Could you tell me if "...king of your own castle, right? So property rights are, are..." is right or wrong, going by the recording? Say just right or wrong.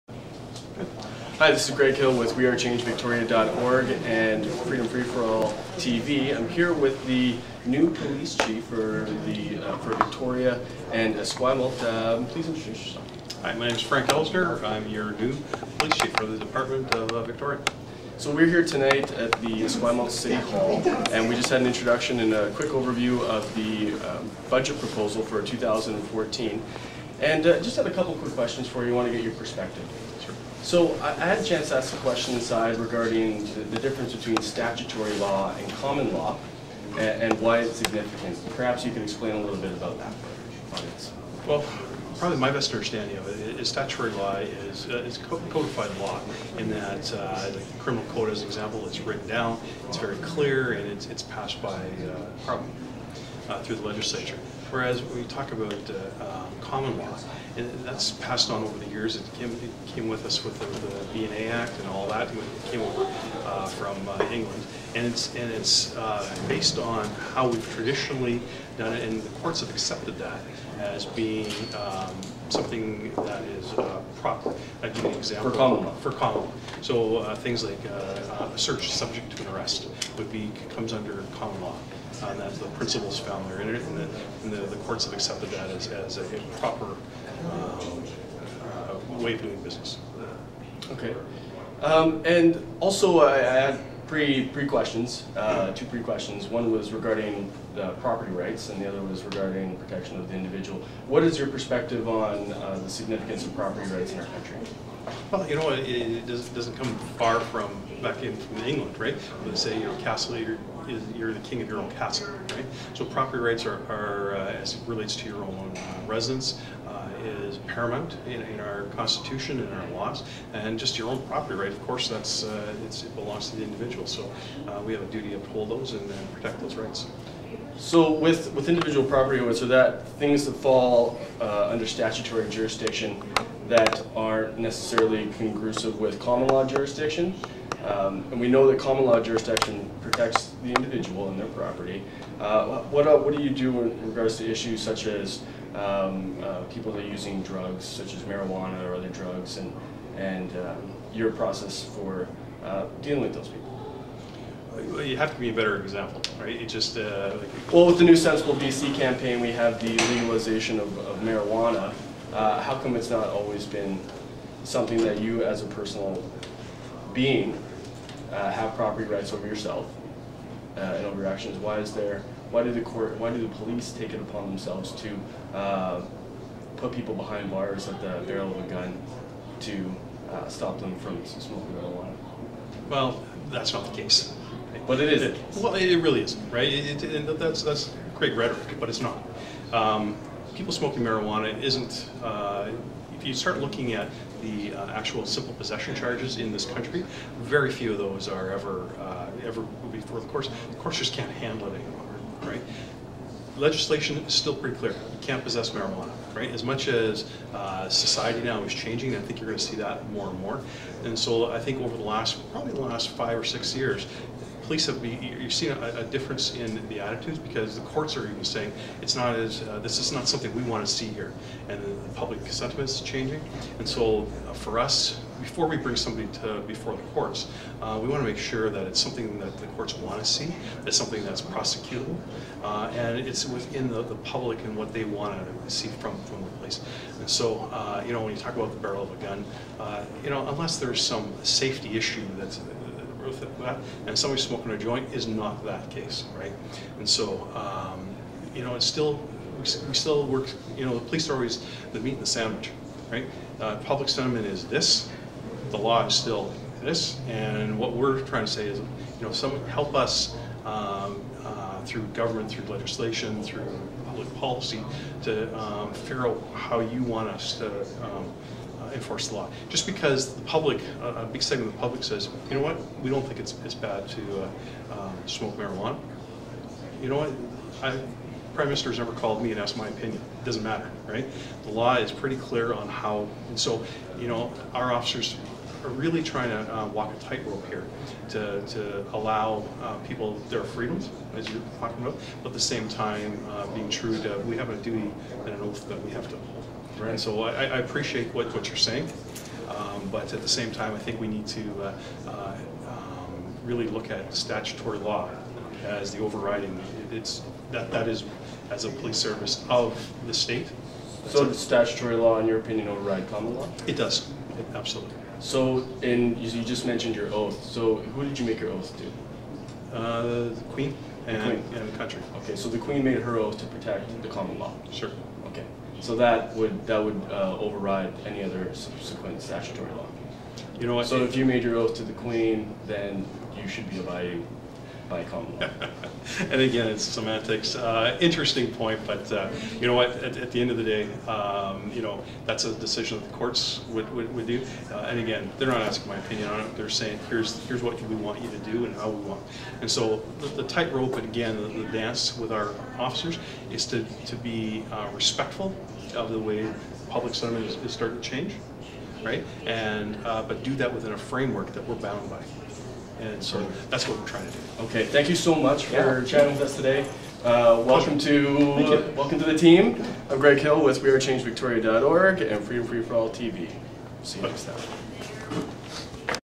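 right.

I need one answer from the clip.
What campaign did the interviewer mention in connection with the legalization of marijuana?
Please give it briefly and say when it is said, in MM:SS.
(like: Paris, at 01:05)
Sensible BC, at 02:38.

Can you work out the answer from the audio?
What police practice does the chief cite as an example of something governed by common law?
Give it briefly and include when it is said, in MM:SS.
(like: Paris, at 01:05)
search subject to an arrest, at 01:18.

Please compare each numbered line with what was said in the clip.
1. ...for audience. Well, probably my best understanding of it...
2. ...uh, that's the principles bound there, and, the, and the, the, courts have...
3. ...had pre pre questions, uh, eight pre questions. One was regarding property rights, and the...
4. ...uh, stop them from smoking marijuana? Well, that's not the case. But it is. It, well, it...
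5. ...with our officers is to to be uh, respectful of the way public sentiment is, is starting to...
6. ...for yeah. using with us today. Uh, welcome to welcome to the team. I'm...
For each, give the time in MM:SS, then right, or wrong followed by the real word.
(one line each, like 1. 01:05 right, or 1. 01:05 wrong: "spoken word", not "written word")
1. 00:40 right
2. 01:22 wrong: "found", not "bound"
3. 01:33 wrong: "two", not "eight"
4. 03:00 right
5. 05:52 right
6. 06:05 wrong: "chatting", not "using".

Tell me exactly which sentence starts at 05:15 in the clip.
So, and you, just mentioned your oath.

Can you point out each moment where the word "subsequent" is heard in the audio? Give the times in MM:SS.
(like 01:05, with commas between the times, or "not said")
05:28.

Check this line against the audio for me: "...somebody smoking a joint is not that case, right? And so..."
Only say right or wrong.
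right.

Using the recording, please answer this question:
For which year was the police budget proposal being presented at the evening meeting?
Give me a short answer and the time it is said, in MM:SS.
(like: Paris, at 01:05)
2014, at 00:25.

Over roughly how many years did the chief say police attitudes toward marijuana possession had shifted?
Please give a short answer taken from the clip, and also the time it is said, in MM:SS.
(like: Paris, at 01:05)
5 or 6, at 03:33.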